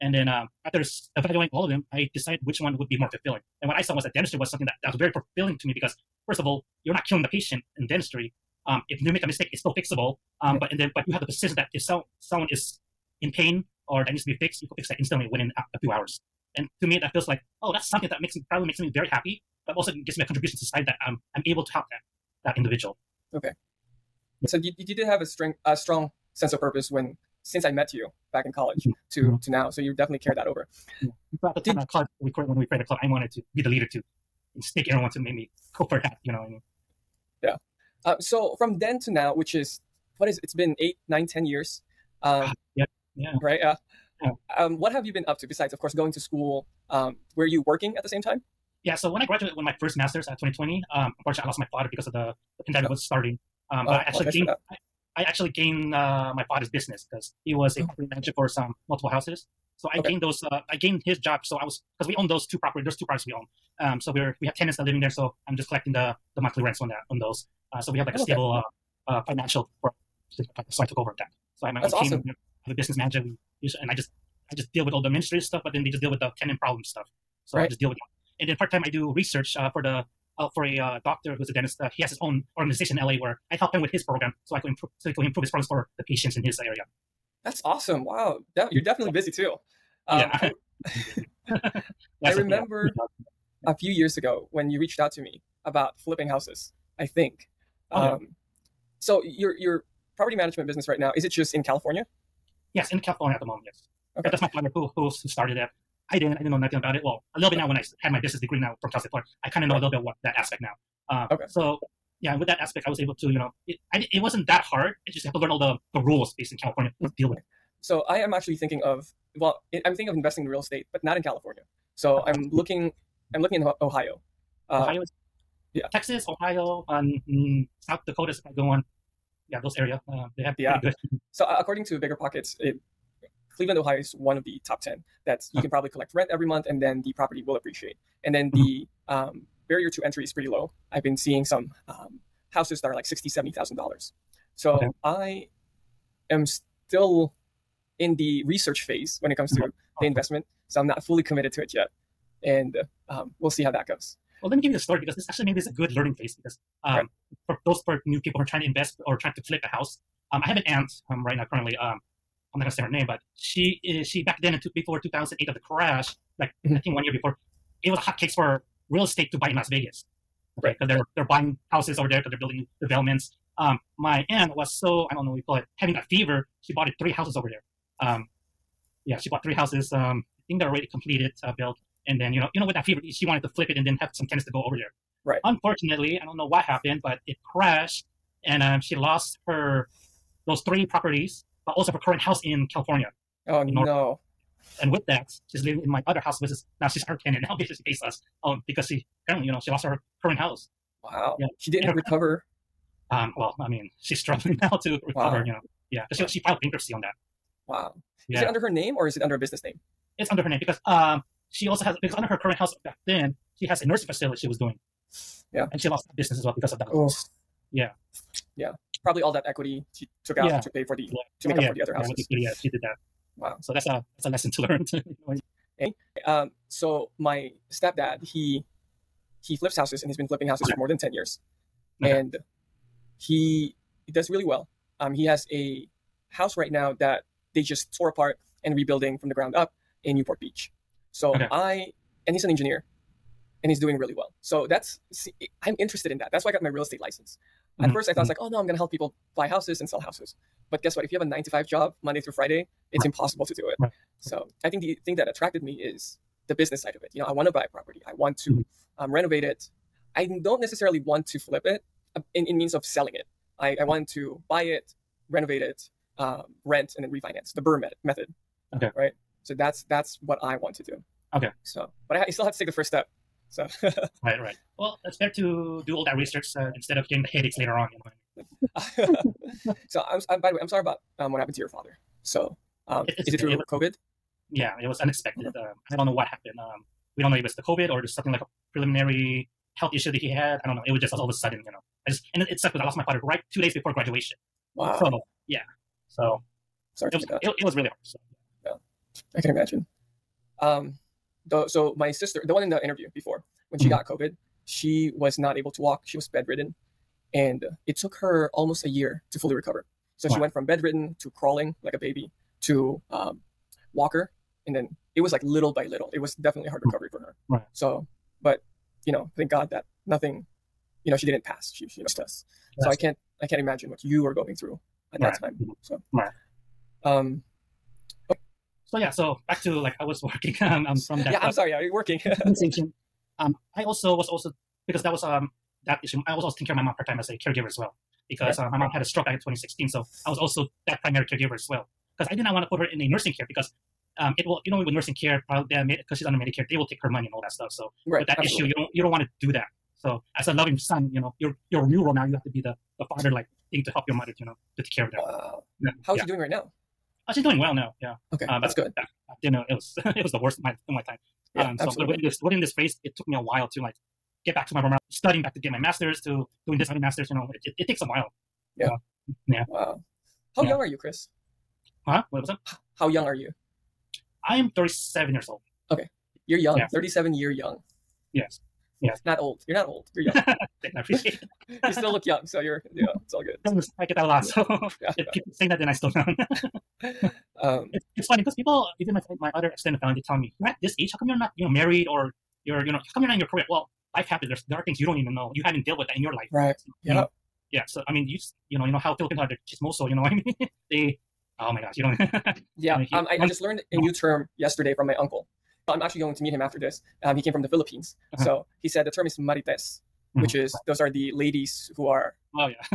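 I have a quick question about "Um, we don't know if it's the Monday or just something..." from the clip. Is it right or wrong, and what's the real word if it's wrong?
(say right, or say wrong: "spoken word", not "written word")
wrong: "COVID", not "Monday".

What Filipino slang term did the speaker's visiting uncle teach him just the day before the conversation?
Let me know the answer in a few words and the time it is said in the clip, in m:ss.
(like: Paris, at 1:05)
marites, at 6:49.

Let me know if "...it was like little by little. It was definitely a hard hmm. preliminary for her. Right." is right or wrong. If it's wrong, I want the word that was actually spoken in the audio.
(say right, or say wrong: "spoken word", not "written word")
wrong: "recovery", not "preliminary".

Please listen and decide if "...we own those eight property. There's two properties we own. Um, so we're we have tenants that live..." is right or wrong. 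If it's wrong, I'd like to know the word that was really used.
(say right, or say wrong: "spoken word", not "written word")
wrong: "two", not "eight".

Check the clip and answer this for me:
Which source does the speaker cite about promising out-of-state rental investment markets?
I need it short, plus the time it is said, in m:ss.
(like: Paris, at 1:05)
BiggerPockets, at 2:11.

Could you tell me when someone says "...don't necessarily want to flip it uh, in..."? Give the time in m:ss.
4:20.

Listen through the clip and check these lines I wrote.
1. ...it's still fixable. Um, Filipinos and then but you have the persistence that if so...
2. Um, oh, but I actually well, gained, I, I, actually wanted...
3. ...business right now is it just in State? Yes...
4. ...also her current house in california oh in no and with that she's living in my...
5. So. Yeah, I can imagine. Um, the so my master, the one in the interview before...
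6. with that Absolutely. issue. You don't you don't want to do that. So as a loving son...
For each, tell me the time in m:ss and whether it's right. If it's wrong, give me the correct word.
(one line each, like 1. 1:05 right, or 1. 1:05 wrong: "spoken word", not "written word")
1. 0:09 wrong: "But", not "Filipinos"
2. 0:53 wrong: "gained", not "wanted"
3. 1:40 wrong: "California", not "State"
4. 3:11 right
5. 4:58 wrong: "sister", not "master"
6. 5:48 right.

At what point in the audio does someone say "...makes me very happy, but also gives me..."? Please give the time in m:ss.
0:18.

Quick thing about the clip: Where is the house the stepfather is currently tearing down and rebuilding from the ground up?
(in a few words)
Newport Beach.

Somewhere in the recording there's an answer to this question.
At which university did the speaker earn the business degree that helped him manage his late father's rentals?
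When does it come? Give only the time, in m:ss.
1:48.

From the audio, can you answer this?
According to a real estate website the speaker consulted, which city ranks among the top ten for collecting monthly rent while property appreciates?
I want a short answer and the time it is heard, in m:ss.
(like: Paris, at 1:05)
Cleveland, Ohio, at 2:13.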